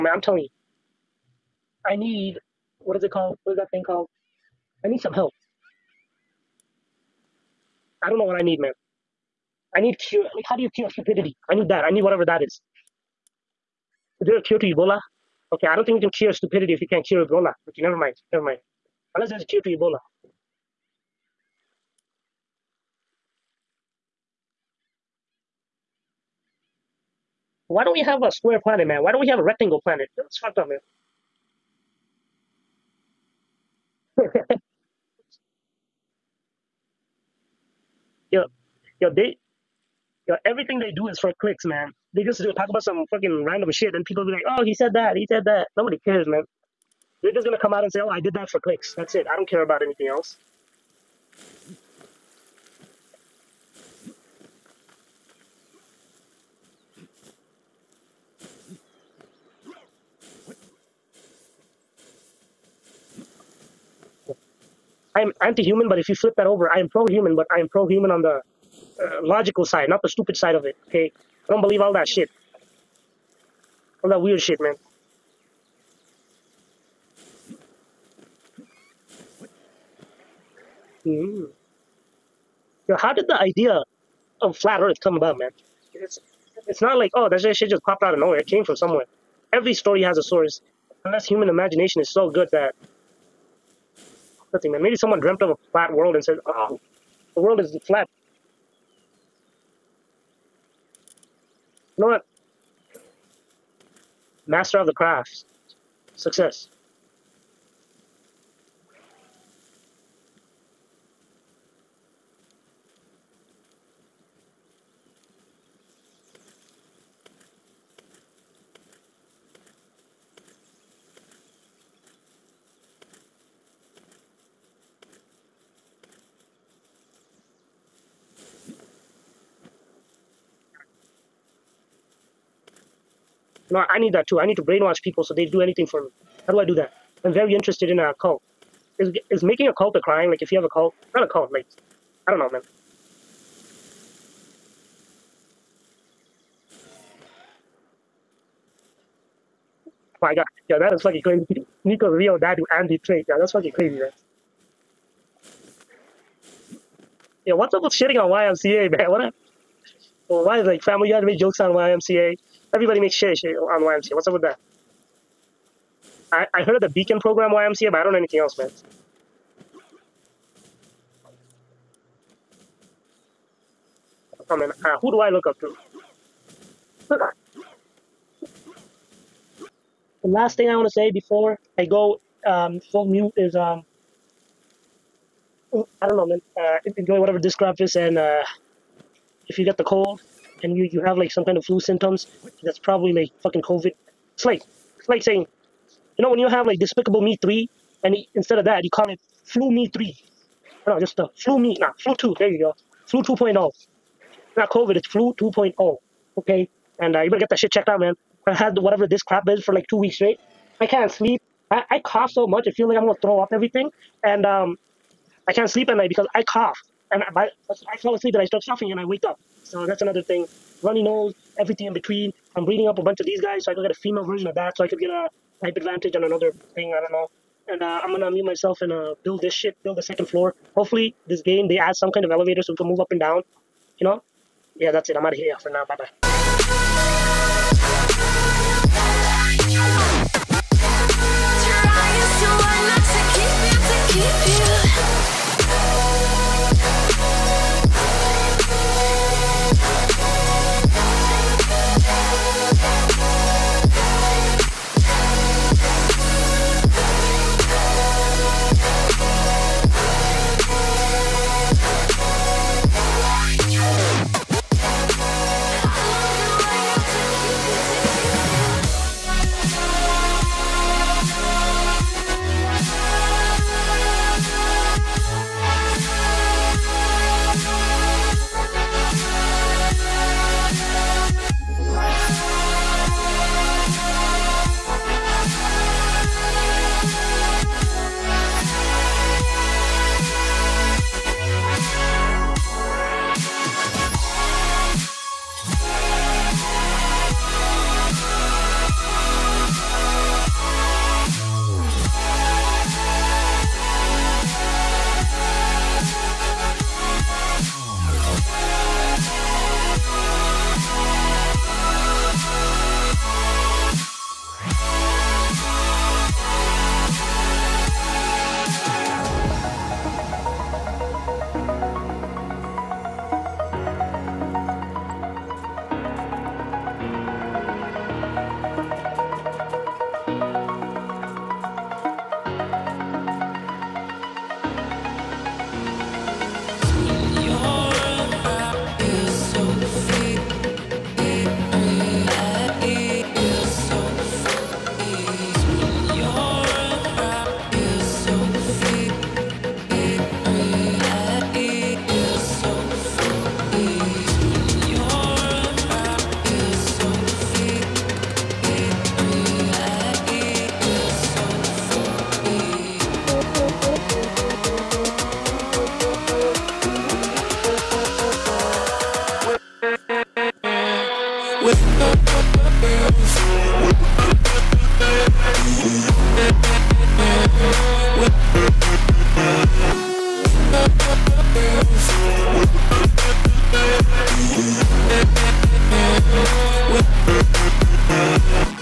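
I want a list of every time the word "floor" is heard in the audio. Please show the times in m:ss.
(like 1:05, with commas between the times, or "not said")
3:50.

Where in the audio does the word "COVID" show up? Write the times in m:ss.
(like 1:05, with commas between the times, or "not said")
3:13, 3:24.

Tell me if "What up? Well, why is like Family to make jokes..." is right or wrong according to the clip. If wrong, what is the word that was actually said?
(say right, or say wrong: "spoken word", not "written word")
right.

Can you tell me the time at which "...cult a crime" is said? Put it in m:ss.
2:19.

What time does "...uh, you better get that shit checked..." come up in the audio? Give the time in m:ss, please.
3:27.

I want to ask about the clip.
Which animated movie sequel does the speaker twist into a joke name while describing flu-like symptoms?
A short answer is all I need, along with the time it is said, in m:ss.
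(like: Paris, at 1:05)
Despicable Me 3, at 3:16.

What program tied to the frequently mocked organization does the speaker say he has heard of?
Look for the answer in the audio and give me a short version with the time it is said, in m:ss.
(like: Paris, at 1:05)
Beacon program, at 2:46.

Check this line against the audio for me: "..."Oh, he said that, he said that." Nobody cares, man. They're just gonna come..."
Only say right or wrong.
right.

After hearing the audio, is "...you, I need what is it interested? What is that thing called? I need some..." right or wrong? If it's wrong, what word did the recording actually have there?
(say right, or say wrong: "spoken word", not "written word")
wrong: "called", not "interested".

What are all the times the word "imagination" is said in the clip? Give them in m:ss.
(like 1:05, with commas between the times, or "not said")
1:31.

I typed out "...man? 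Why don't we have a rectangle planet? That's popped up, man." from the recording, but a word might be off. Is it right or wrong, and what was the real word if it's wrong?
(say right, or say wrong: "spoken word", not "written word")
wrong: "fucked", not "popped".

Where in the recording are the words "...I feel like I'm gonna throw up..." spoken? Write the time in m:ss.
3:32.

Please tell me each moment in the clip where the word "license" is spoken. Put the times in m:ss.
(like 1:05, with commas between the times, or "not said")
not said.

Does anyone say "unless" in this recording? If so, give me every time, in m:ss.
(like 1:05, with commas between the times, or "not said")
0:19, 1:31.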